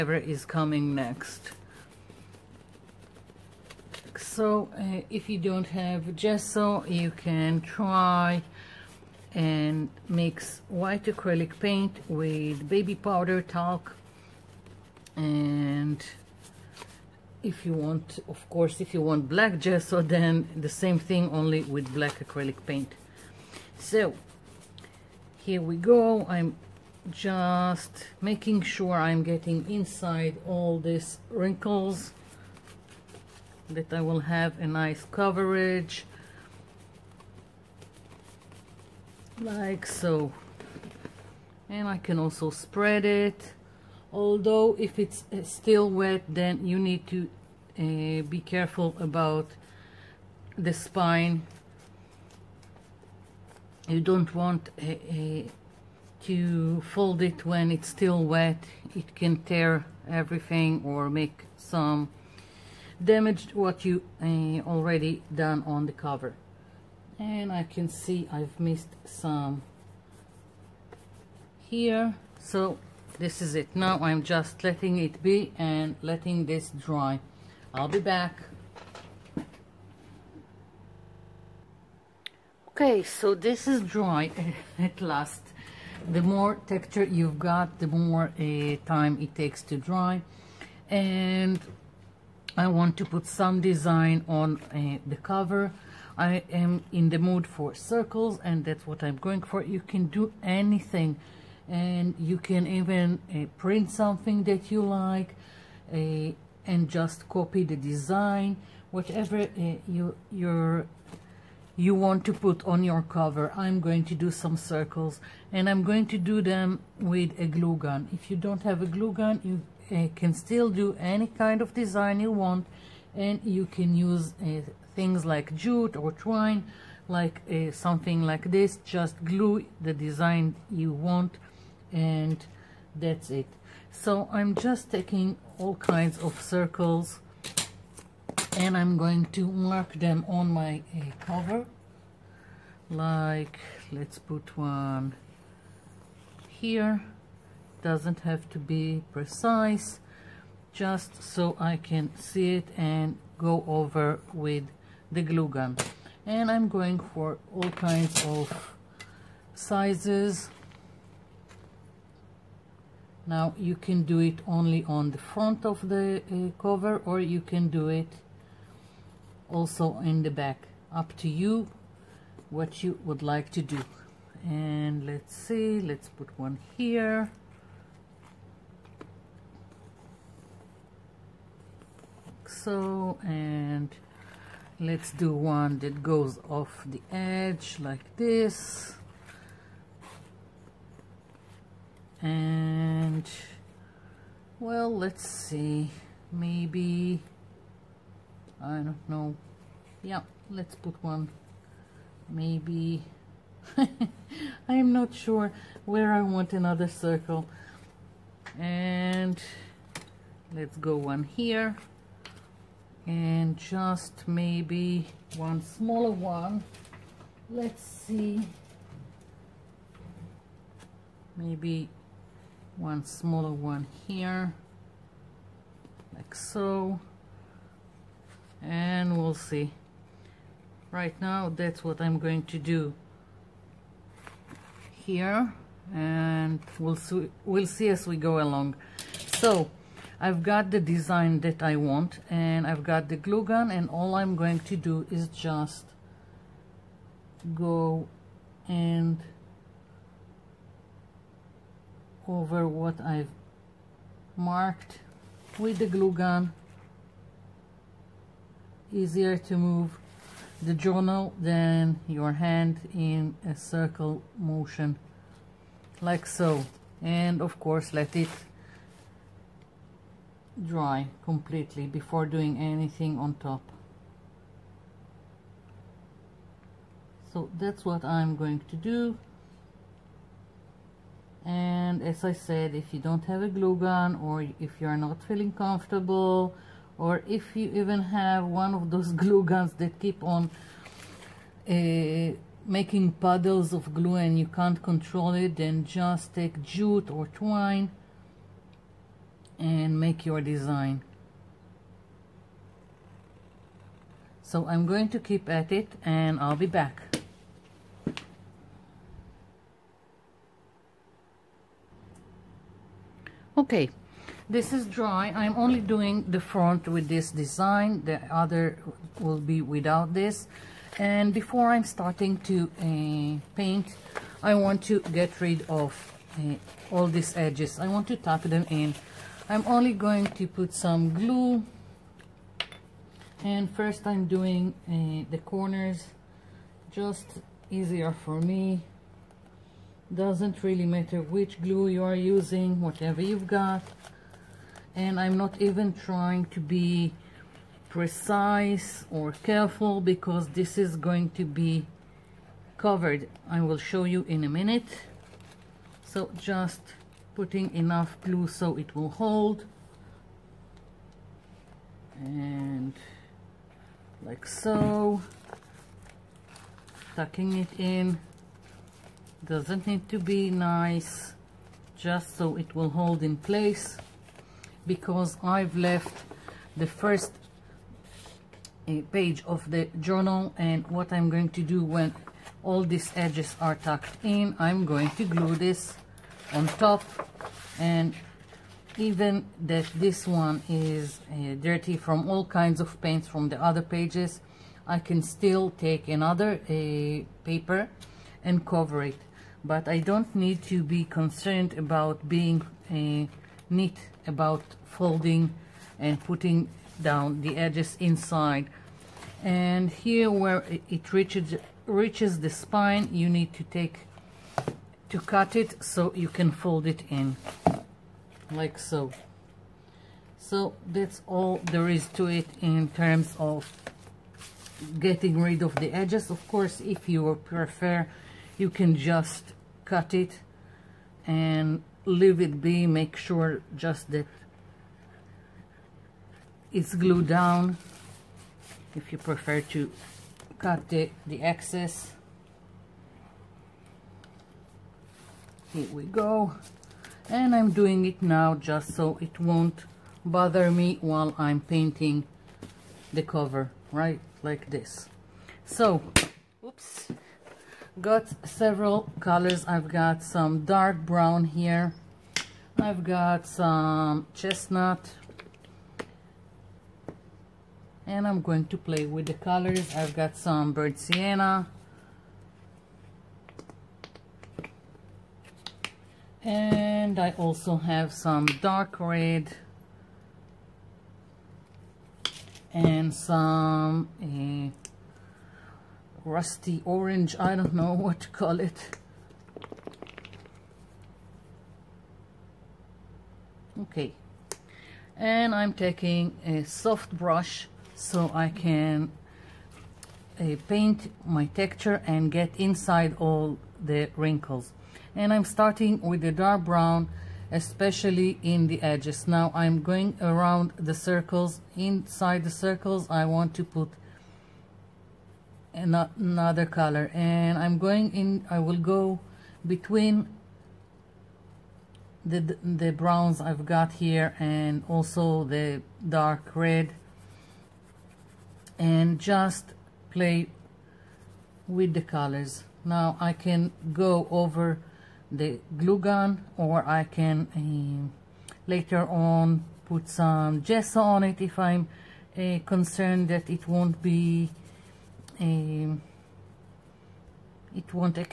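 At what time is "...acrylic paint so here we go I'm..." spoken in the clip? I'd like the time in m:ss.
0:22.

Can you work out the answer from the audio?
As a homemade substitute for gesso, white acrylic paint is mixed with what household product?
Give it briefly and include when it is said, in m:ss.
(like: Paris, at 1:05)
baby powder, at 0:12.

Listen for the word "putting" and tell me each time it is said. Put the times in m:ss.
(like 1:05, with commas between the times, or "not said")
5:57, 6:46.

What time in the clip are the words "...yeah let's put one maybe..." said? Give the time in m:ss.
3:20.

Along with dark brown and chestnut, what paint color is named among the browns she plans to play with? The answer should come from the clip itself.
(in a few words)
burnt sienna.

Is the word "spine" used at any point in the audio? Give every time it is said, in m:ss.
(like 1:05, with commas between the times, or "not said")
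0:50, 6:52.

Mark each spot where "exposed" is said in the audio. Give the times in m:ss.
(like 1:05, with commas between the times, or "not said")
not said.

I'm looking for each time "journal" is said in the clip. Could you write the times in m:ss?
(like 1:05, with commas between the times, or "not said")
4:20, 6:19.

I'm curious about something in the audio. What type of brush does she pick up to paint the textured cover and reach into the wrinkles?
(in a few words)
a soft brush.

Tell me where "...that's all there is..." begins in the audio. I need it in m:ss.
7:00.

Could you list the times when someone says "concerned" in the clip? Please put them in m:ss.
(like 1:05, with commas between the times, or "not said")
6:41, 9:02.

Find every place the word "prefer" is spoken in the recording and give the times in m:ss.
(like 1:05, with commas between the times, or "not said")
7:07, 7:19.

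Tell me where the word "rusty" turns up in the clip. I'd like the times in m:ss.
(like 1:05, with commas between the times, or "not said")
8:06.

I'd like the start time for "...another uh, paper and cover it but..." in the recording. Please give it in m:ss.
6:36.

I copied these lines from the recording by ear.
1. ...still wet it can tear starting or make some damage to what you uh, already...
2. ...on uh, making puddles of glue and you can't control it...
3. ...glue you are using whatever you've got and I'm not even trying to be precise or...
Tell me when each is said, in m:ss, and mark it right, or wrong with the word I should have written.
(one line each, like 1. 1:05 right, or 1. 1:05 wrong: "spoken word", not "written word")
1. 0:57 wrong: "everything", not "starting"
2. 4:50 right
3. 5:41 right.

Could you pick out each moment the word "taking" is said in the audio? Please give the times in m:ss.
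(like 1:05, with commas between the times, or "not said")
2:14, 8:15.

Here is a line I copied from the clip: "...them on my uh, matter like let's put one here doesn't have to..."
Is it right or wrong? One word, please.
wrong.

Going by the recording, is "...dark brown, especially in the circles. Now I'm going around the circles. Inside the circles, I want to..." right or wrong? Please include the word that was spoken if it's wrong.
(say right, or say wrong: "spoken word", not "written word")
wrong: "edges", not "circles".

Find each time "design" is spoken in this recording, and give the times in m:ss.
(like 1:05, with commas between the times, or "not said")
1:33, 1:47, 2:01, 2:09, 4:00, 5:00, 5:17.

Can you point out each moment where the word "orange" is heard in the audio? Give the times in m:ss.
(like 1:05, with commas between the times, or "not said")
8:06.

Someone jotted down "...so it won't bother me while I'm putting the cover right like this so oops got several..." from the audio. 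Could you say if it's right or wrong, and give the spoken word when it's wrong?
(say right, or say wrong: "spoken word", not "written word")
wrong: "painting", not "putting".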